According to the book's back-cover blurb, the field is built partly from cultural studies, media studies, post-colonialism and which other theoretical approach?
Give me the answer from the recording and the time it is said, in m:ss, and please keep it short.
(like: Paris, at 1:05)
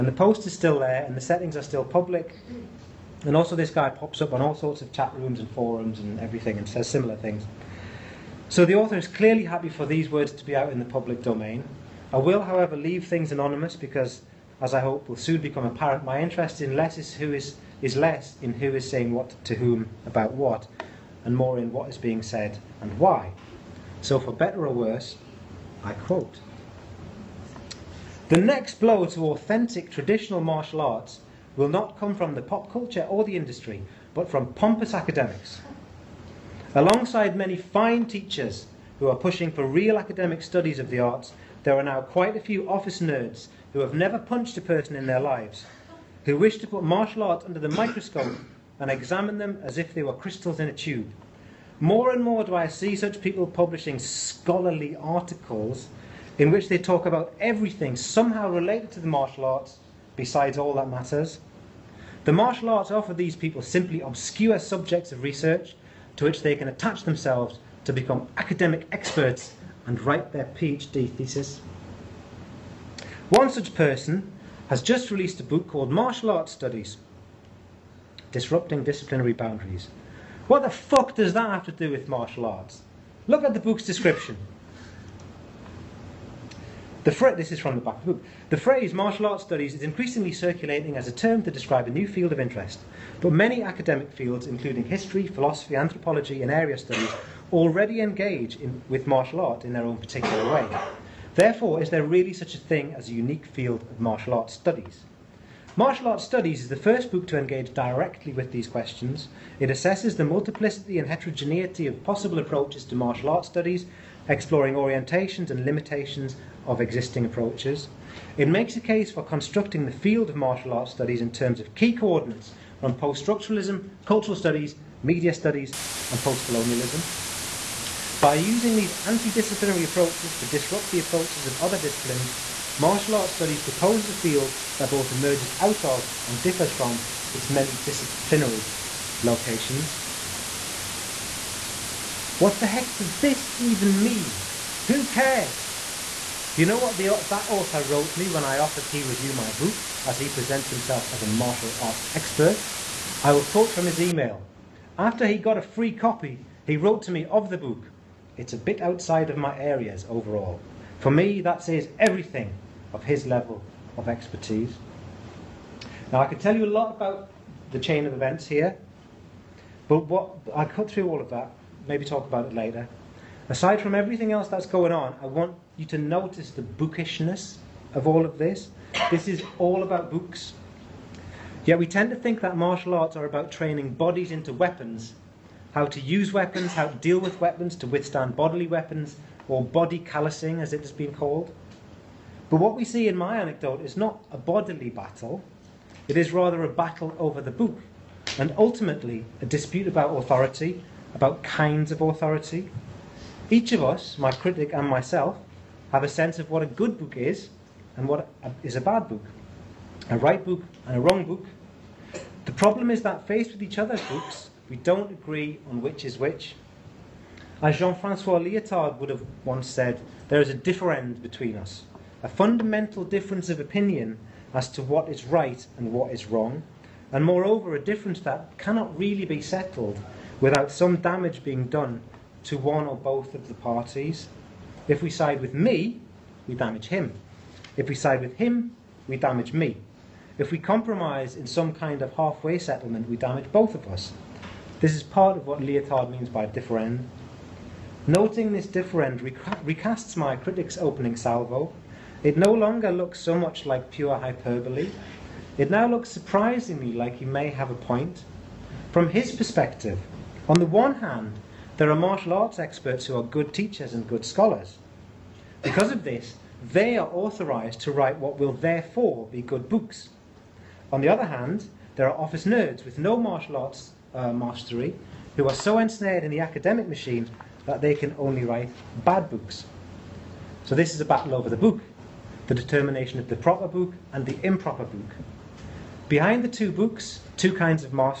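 post-structuralism, at 2:02.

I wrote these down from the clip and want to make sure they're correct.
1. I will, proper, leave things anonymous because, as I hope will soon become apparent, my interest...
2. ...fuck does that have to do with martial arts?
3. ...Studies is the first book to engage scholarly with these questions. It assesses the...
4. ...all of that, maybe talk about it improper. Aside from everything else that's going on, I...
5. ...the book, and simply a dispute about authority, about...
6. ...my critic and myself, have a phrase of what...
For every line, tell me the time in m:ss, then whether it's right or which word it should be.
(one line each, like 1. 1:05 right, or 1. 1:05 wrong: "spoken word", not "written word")
1. 0:12 wrong: "however", not "proper"
2. 1:20 right
3. 1:46 wrong: "directly", not "scholarly"
4. 2:51 wrong: "later", not "improper"
5. 3:17 wrong: "ultimately", not "simply"
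6. 3:24 wrong: "sense", not "phrase".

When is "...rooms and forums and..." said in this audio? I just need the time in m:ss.
0:05.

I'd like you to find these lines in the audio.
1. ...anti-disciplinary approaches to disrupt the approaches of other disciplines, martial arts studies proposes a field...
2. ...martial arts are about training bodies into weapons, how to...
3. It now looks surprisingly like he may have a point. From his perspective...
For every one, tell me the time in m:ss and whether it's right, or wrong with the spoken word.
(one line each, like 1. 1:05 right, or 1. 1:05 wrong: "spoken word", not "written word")
1. 2:09 right
2. 3:02 right
3. 4:15 right.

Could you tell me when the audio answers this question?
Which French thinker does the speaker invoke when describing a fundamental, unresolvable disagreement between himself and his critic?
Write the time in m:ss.
3:37.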